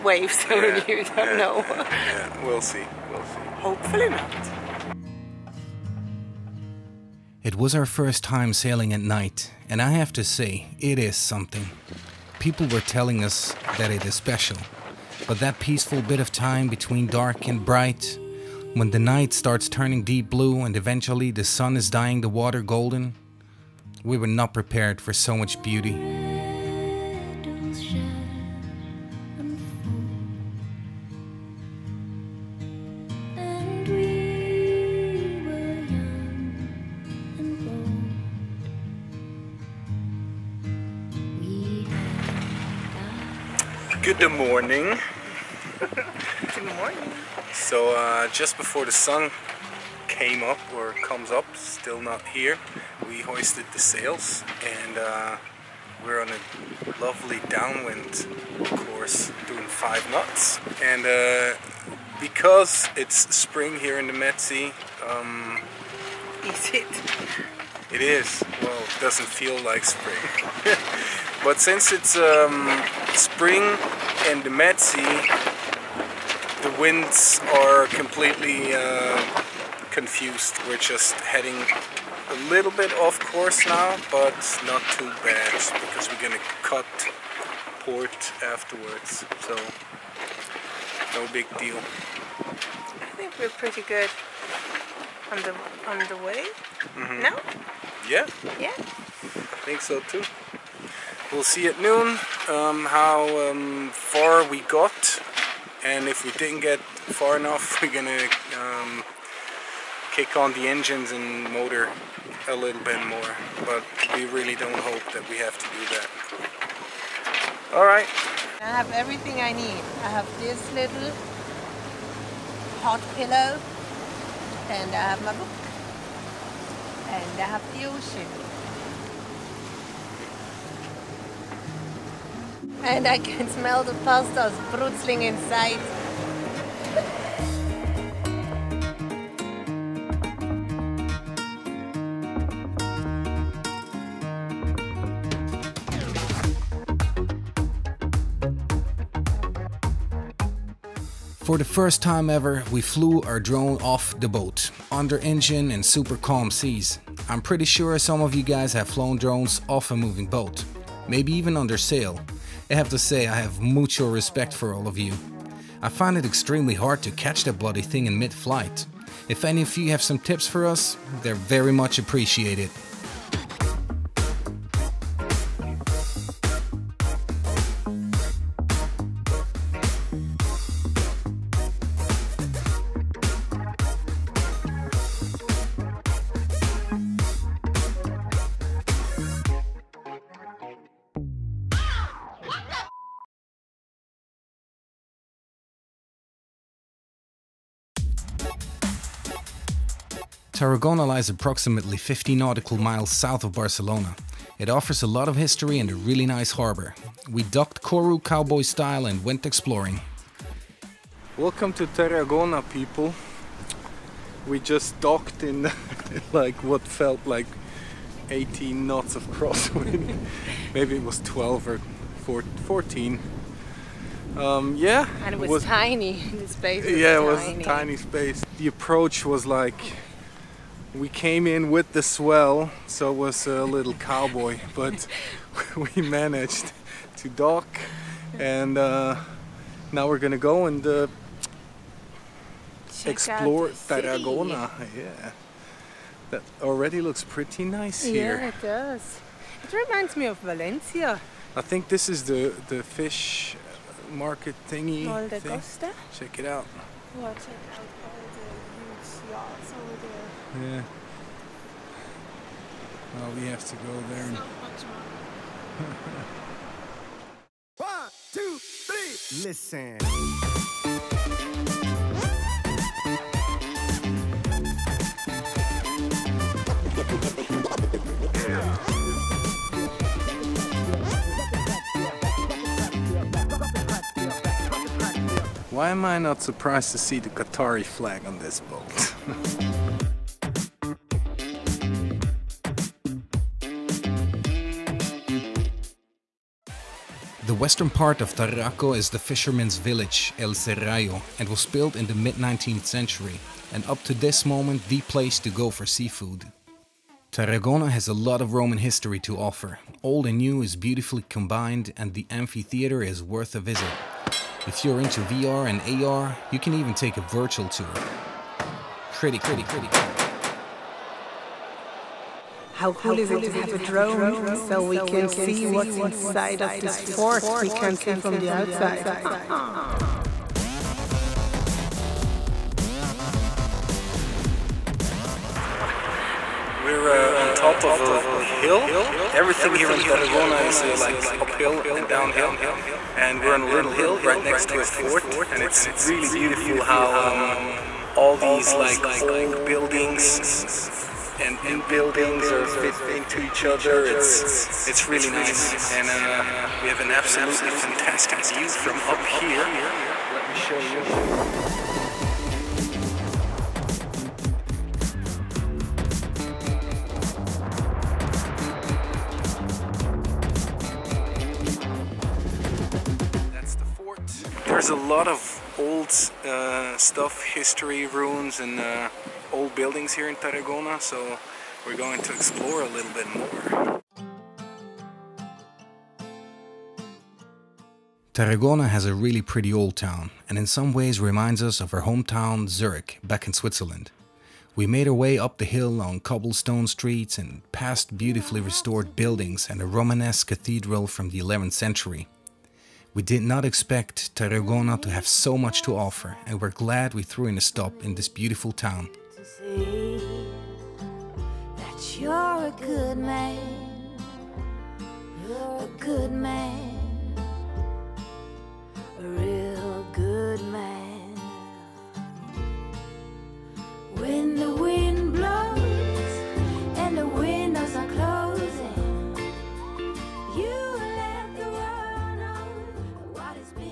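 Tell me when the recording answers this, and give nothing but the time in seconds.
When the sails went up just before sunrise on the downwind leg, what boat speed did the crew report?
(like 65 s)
59 s.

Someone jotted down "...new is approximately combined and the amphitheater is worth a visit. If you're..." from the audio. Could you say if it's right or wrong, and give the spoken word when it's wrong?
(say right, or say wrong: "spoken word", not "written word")
wrong: "beautifully", not "approximately".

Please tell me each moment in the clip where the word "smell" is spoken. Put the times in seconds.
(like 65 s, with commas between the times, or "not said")
133 s.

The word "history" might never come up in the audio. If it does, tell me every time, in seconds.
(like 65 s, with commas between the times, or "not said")
205 s, 308 s, 377 s.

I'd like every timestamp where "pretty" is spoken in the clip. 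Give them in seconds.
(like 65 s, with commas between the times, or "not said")
93 s, 157 s, 247 s, 319 s, 389 s.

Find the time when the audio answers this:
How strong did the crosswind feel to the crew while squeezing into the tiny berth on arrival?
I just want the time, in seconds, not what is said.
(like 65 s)
218 s.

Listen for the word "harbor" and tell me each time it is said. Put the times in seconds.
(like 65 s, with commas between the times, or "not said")
206 s.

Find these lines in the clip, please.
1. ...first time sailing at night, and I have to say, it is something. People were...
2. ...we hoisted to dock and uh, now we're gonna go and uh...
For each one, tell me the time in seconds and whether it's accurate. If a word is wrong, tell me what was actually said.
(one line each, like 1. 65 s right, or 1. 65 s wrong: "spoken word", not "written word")
1. 7 s right
2. 235 s wrong: "managed", not "hoisted".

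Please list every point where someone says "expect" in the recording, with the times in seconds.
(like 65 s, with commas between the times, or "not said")
403 s.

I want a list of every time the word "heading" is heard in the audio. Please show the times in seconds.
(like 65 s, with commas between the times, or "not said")
81 s.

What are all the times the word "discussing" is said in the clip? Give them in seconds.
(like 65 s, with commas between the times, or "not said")
not said.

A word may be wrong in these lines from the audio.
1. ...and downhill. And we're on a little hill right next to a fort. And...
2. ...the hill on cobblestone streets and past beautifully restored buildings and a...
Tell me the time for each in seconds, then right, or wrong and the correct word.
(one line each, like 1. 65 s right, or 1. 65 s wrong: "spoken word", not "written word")
1. 341 s right
2. 395 s right.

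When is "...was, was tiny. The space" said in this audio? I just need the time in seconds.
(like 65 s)
225 s.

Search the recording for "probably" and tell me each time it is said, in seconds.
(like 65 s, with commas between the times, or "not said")
not said.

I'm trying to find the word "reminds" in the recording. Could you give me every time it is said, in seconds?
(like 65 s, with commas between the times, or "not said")
249 s, 391 s.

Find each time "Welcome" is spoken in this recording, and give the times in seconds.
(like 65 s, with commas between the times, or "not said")
211 s.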